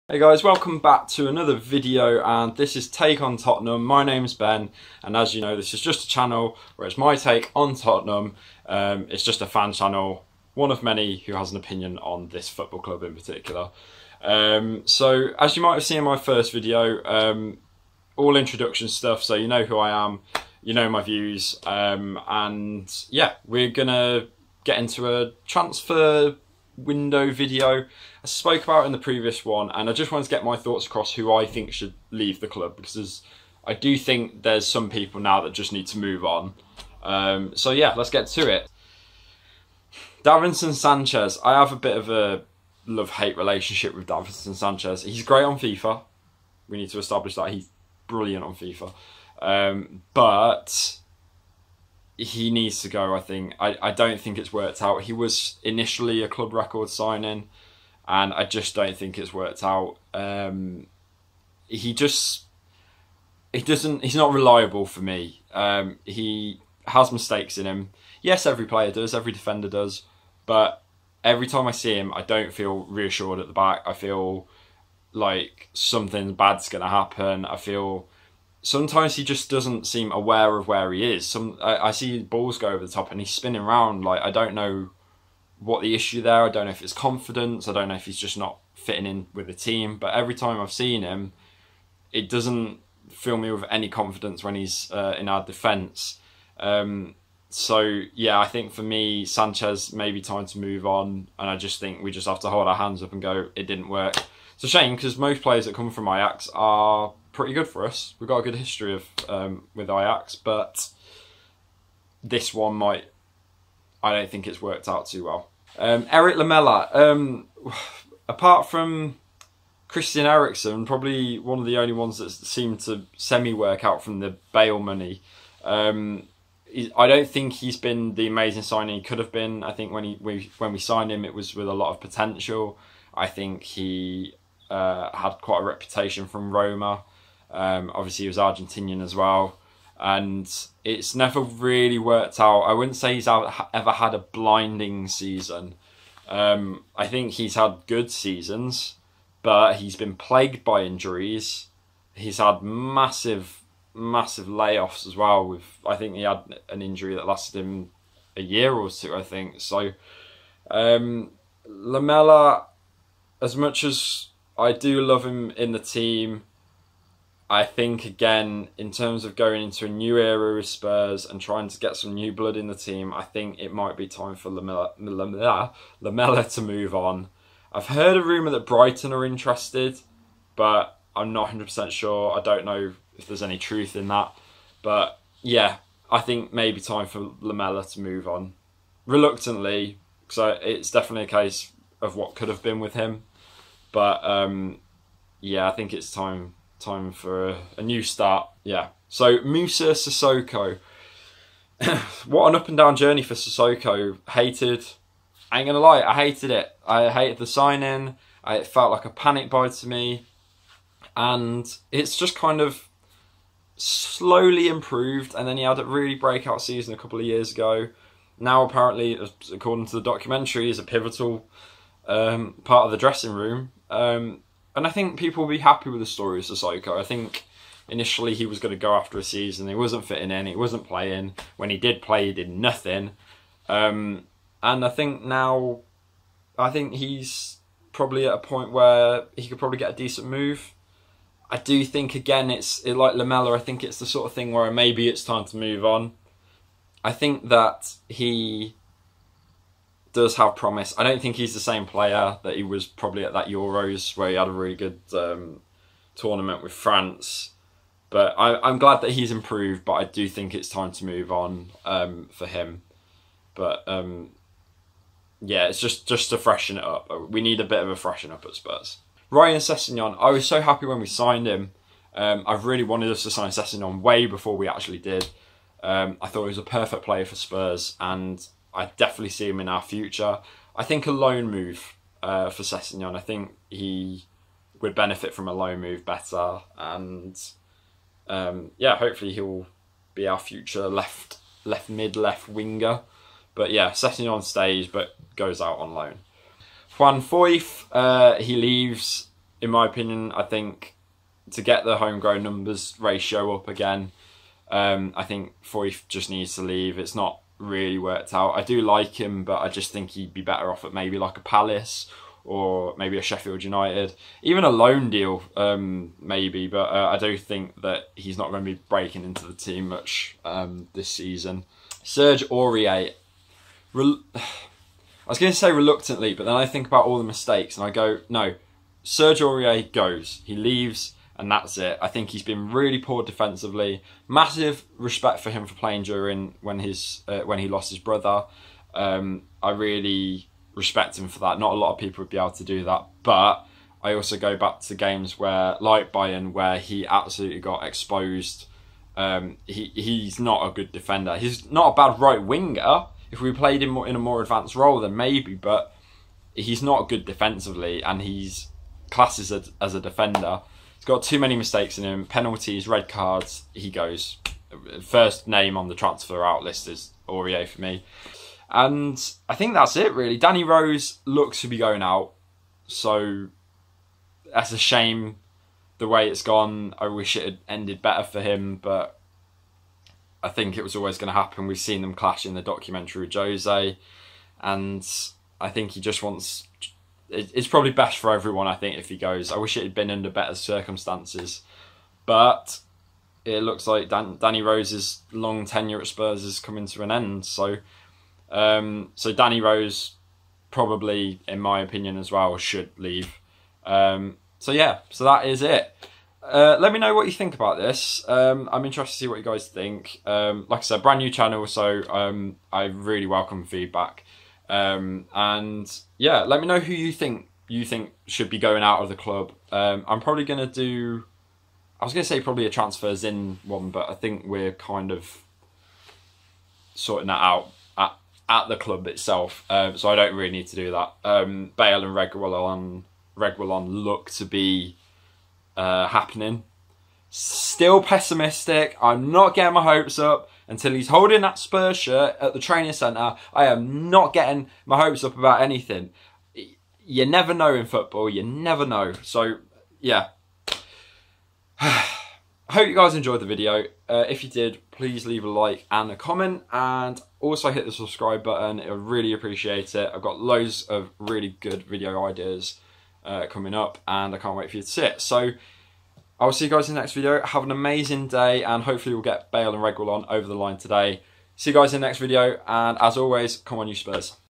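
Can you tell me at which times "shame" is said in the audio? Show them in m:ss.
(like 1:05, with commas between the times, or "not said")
1:44, 6:14.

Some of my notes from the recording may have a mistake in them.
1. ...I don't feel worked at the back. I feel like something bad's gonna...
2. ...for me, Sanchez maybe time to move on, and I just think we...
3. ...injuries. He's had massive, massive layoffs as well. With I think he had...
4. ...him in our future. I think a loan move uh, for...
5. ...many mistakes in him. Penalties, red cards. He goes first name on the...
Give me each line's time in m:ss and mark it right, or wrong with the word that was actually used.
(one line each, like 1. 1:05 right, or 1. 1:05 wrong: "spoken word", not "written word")
1. 1:12 wrong: "reassured", not "worked"
2. 1:38 right
3. 2:30 right
4. 4:39 right
5. 6:01 right.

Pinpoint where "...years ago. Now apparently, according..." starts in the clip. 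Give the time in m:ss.
3:37.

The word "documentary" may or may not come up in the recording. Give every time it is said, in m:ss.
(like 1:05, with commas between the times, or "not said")
3:40, 6:22.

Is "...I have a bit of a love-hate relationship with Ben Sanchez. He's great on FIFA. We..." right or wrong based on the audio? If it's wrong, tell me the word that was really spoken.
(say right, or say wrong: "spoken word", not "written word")
wrong: "Davinson", not "Ben".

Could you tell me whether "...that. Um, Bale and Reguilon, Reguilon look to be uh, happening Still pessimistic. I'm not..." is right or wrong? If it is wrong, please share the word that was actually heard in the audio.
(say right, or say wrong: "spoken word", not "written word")
right.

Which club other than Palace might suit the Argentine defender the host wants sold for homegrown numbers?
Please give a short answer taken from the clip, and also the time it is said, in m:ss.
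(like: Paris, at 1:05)
Sheffield United, at 5:13.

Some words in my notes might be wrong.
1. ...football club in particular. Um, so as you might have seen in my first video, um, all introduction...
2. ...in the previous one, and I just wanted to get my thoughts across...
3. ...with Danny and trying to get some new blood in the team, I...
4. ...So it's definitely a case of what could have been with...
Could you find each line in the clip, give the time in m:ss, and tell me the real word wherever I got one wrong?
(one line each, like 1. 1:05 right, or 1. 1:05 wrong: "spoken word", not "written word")
1. 0:12 right
2. 0:28 right
3. 2:50 wrong: "Spurs", not "Danny"
4. 3:10 right.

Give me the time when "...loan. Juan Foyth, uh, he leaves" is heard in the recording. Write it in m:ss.
4:55.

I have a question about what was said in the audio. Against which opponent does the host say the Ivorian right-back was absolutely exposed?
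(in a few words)
Bayern.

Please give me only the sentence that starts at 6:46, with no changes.
Uh, let me know what you think about this.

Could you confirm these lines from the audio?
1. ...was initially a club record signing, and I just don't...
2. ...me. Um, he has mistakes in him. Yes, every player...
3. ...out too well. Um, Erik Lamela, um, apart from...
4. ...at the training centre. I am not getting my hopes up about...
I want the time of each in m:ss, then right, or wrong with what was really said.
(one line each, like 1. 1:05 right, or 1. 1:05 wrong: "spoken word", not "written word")
1. 0:55 right
2. 1:05 right
3. 1:54 right
4. 7:22 right.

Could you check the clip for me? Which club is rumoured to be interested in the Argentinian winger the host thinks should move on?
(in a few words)
Brighton.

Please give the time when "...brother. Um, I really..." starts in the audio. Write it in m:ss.
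5:37.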